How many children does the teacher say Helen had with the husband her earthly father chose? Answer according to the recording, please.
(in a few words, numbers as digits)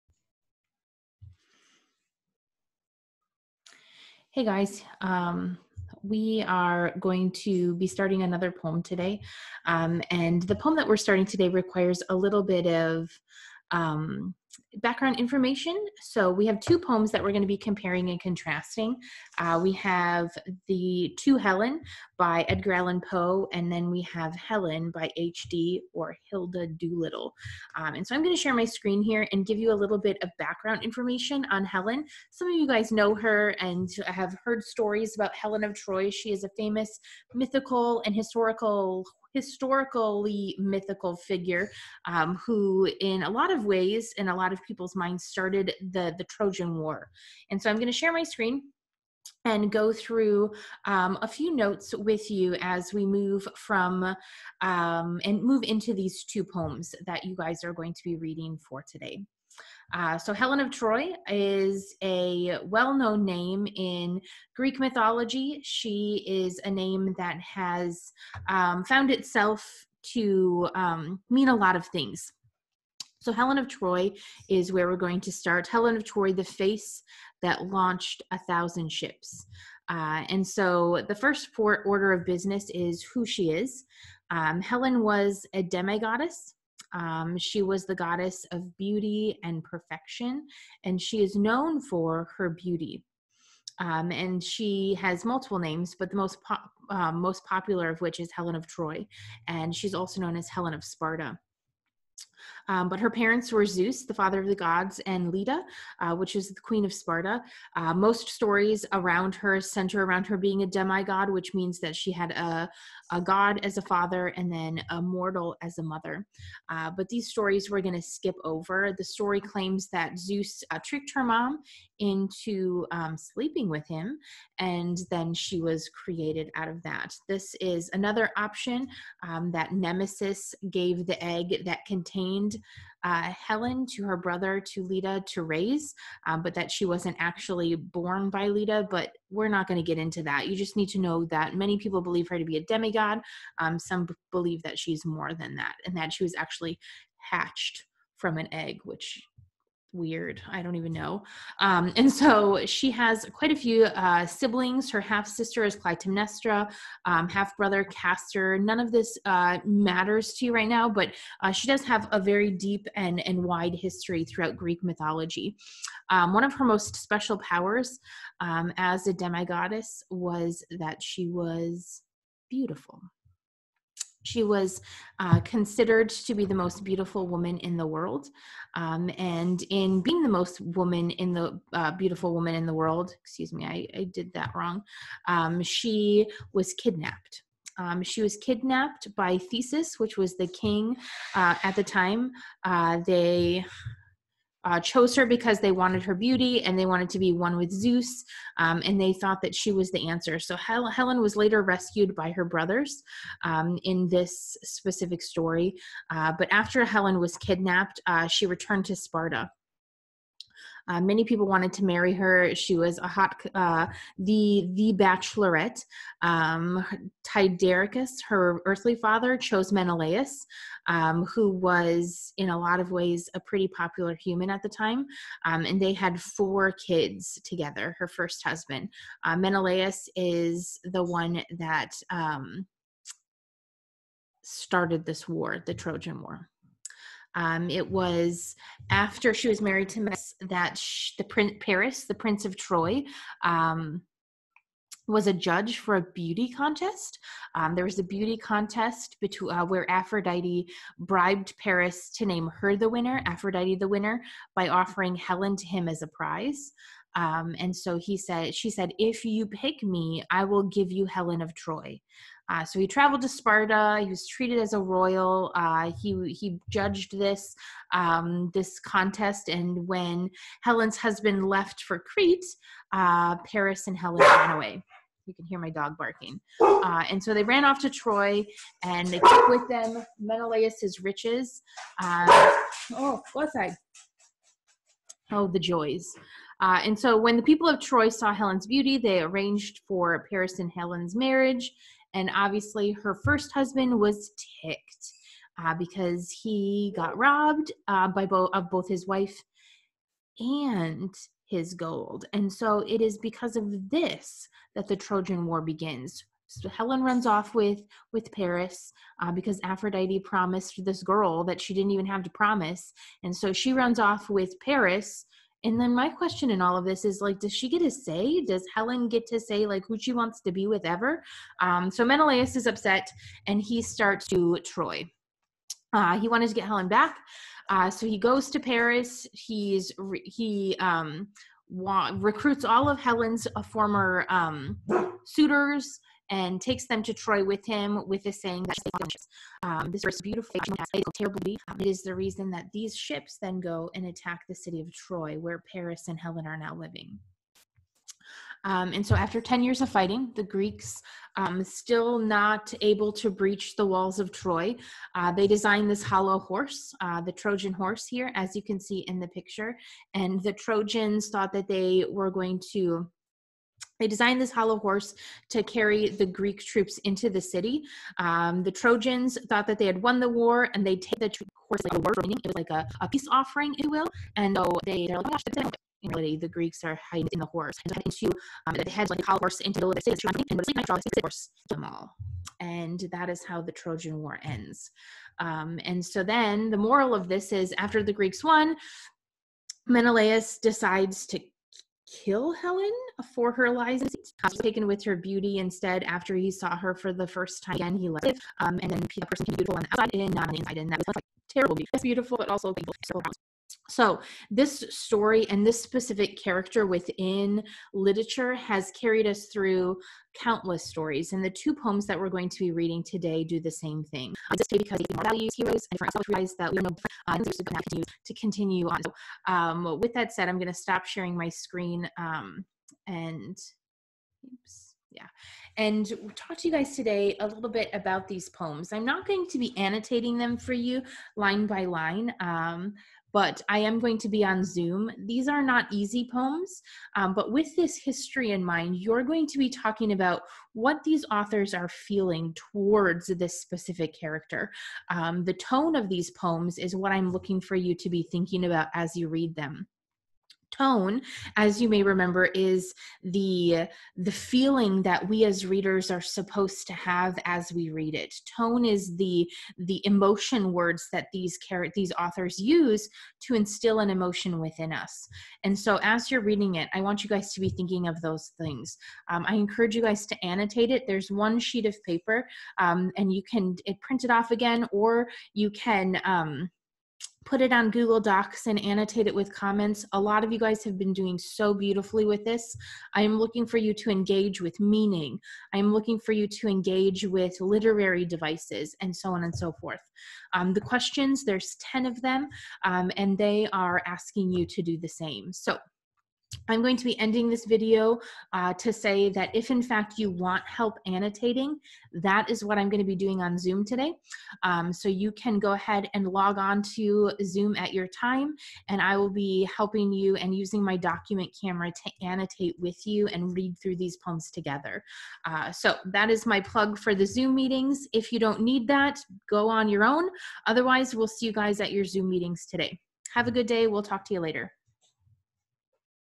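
4.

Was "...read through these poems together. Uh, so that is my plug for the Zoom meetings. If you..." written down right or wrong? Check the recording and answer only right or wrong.
right.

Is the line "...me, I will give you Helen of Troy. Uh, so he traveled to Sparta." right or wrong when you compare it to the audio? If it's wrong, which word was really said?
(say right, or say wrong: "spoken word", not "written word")
right.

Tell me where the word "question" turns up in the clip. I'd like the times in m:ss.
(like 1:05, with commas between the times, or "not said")
5:16, 8:10.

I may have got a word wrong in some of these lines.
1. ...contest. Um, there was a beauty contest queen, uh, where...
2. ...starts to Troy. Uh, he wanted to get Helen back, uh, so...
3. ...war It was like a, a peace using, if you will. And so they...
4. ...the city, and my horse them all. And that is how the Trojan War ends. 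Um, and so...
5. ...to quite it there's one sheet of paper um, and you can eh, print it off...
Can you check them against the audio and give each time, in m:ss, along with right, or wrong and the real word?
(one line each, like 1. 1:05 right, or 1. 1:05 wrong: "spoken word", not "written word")
1. 4:06 wrong: "between", not "queen"
2. 5:23 right
3. 6:11 wrong: "offering", not "using"
4. 6:19 right
5. 7:50 wrong: "annotate", not "quite".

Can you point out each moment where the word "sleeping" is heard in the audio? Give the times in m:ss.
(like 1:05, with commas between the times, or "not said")
2:03.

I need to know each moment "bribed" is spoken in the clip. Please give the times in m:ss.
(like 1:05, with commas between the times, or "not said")
4:10.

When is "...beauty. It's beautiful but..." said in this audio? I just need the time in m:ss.
6:41.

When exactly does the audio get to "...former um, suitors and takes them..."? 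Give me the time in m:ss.
5:33.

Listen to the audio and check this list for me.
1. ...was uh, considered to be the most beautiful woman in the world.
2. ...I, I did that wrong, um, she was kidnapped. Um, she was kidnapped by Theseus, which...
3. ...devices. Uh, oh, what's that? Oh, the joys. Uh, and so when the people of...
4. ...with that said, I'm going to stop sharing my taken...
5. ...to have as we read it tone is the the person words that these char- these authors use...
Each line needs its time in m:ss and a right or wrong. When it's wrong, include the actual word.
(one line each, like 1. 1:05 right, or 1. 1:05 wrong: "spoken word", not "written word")
1. 2:54 right
2. 3:03 right
3. 4:41 wrong: "riches", not "devices"
4. 6:59 wrong: "screen", not "taken"
5. 7:36 wrong: "emotion", not "person".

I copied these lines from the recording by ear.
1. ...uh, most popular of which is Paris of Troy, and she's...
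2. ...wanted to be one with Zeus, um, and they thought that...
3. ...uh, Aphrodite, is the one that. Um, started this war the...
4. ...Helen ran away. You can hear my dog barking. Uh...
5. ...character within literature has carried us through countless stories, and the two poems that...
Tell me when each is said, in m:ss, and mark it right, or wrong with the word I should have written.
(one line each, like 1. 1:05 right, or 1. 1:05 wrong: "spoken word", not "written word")
1. 1:36 wrong: "Helen", not "Paris"
2. 3:16 right
3. 3:49 wrong: "Menelaus", not "Aphrodite"
4. 4:33 right
5. 6:46 right.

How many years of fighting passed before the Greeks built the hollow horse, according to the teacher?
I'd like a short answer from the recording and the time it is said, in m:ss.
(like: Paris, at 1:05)
10, at 5:49.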